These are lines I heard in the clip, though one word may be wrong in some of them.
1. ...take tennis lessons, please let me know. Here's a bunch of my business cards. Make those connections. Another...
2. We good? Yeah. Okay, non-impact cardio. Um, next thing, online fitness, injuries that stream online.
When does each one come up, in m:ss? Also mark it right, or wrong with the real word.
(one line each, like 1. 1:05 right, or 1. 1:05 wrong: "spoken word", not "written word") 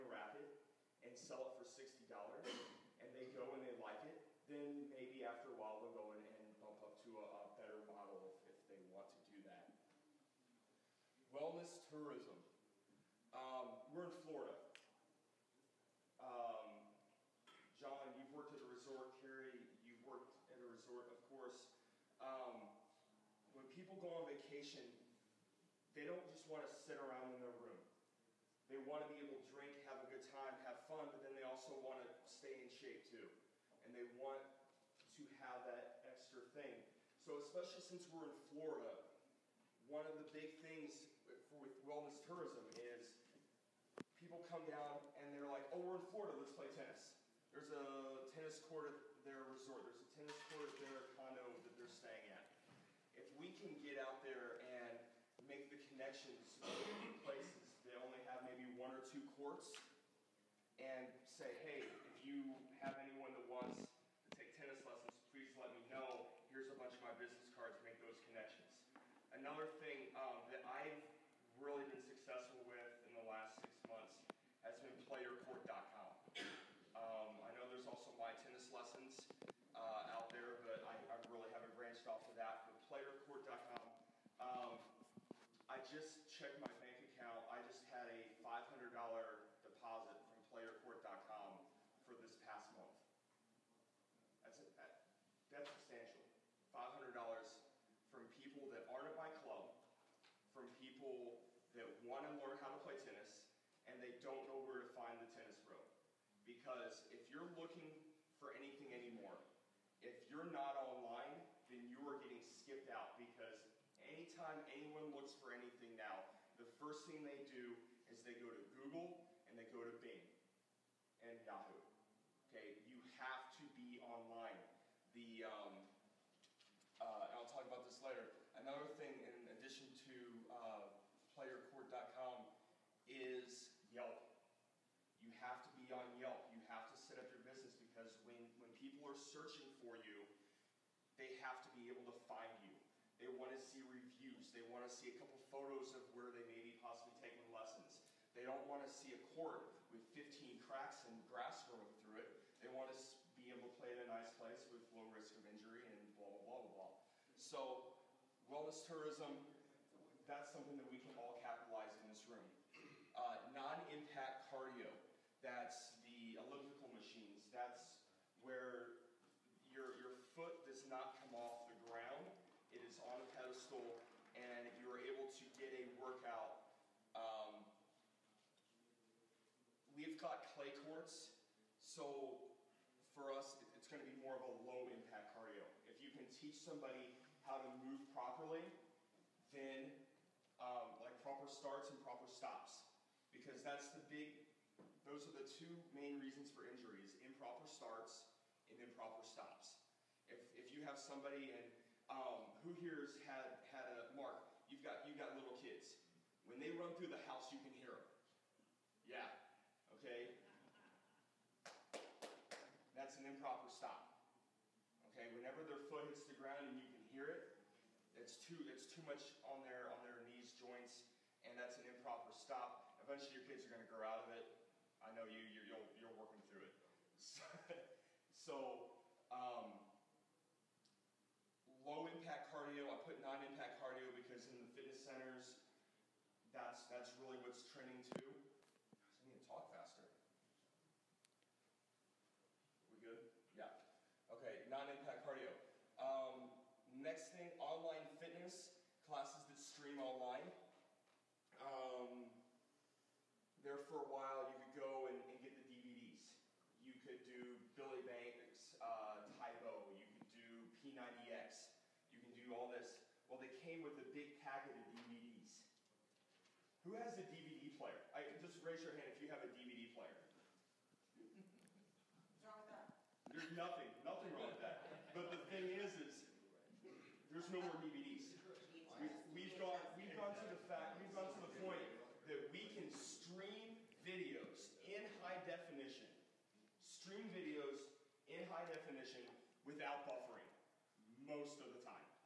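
1. 1:04 right
2. 4:02 wrong: "classes", not "injuries".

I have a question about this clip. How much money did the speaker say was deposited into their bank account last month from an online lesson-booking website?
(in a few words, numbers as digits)
$500.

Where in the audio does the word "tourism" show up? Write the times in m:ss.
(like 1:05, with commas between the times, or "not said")
0:11, 0:42, 2:38.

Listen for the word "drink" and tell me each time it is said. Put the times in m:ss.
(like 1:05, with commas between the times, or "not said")
0:29.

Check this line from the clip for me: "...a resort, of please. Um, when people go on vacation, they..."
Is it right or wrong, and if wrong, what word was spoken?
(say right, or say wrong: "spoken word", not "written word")
wrong: "course", not "please".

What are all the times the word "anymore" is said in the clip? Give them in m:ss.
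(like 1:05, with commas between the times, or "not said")
1:48.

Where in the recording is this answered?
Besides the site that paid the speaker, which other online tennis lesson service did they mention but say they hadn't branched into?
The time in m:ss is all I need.
1:18.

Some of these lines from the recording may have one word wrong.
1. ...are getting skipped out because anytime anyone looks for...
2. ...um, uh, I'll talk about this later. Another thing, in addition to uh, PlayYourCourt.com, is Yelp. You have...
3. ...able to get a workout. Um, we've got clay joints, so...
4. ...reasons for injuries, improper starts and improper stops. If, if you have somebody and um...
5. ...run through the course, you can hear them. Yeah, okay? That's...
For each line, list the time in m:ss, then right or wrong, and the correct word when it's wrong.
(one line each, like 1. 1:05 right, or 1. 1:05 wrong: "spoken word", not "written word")
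1. 1:52 right
2. 2:05 right
3. 2:54 wrong: "courts", not "joints"
4. 3:16 right
5. 3:26 wrong: "house", not "course".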